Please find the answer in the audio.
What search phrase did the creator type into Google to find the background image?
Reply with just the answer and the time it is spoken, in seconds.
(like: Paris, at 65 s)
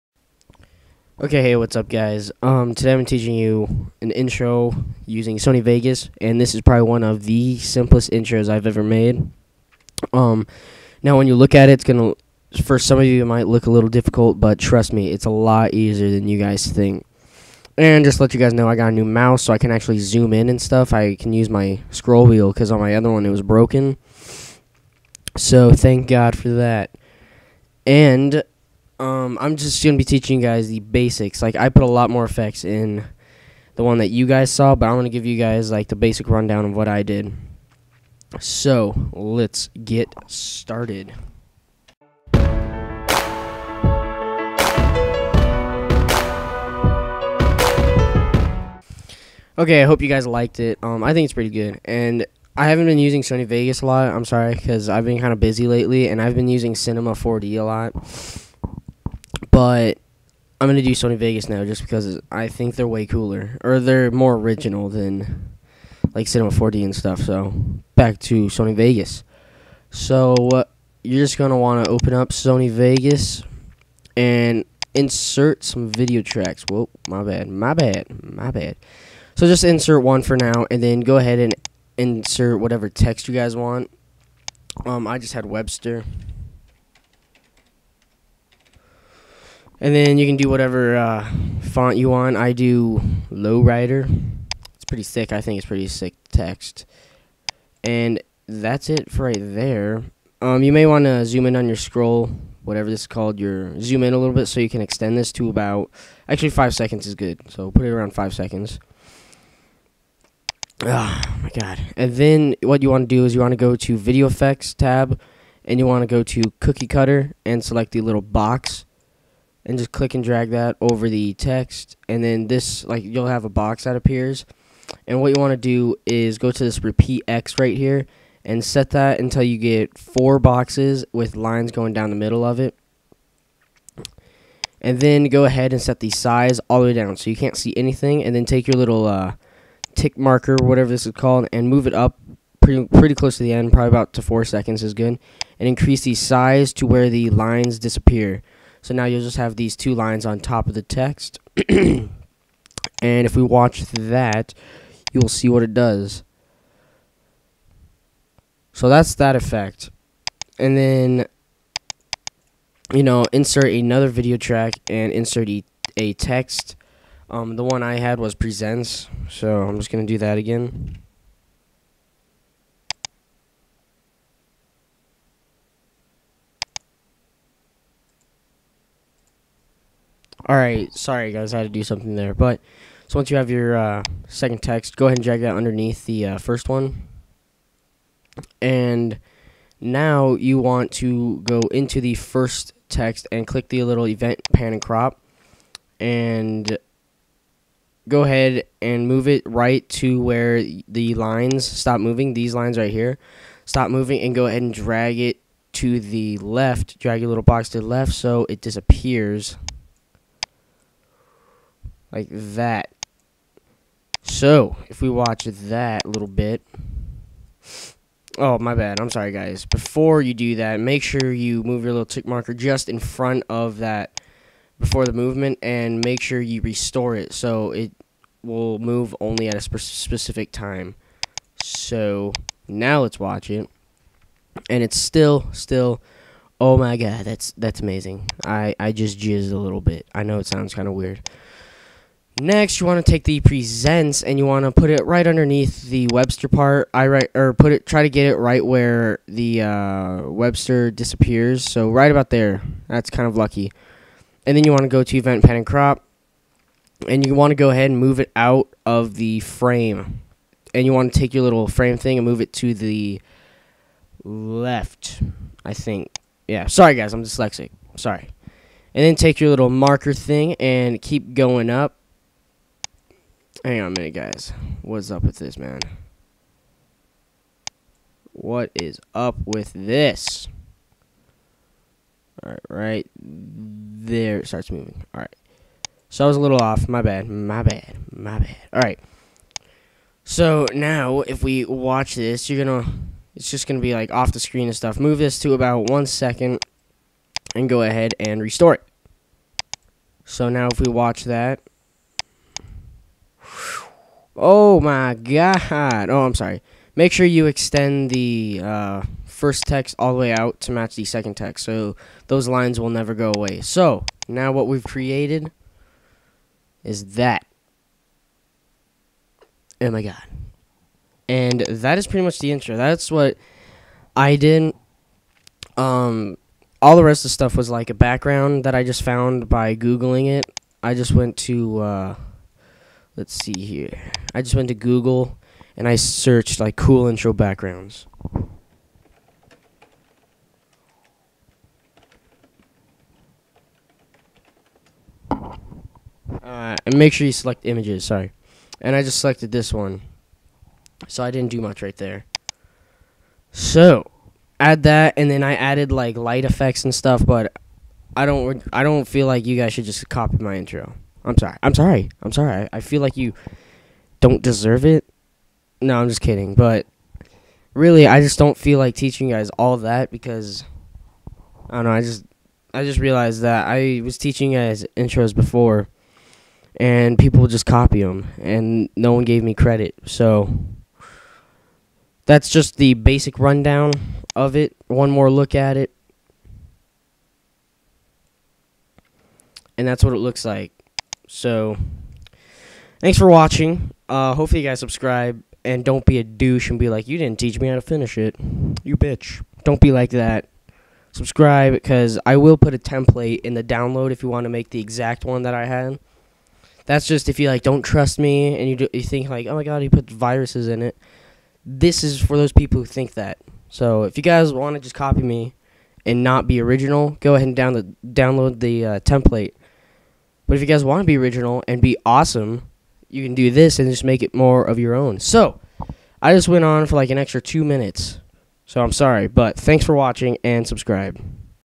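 cool intro backgrounds, at 336 s.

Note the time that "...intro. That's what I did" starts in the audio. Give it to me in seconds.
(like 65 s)
322 s.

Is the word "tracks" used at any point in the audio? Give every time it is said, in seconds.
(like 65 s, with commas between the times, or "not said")
76 s, 164 s.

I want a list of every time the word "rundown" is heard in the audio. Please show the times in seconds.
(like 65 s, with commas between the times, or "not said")
36 s, 383 s.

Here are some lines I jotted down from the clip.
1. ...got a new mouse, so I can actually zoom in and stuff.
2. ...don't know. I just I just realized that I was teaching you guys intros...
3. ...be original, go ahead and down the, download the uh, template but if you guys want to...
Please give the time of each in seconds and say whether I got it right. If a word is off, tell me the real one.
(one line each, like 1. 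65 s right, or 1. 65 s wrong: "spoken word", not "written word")
1. 18 s right
2. 371 s right
3. 416 s right.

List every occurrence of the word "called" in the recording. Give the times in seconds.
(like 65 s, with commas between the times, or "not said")
103 s, 141 s.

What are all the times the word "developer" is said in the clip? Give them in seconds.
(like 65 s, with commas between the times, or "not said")
not said.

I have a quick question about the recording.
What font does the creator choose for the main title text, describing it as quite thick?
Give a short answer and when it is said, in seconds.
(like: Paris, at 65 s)
Lowrider, at 93 s.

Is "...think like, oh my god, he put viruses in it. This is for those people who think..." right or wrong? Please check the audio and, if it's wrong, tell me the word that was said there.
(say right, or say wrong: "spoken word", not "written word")
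right.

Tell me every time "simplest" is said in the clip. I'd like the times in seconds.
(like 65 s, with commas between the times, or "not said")
7 s.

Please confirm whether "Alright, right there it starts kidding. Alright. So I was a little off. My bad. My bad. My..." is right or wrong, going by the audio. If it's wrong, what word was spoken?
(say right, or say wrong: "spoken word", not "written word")
wrong: "moving", not "kidding".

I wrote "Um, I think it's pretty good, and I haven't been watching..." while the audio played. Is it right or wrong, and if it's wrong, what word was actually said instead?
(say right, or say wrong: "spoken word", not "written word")
wrong: "using", not "watching".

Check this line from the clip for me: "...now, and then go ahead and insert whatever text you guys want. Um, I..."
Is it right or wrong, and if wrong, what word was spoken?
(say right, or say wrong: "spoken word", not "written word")
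right.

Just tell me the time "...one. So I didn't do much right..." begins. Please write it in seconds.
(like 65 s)
349 s.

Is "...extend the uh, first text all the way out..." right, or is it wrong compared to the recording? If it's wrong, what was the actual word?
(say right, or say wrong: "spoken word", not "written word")
right.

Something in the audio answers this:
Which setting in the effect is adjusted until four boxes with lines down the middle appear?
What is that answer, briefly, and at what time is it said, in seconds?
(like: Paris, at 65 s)
repeat X, at 126 s.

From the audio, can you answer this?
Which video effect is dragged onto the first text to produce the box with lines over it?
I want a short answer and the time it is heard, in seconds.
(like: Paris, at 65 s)
Cookie Cutter, at 116 s.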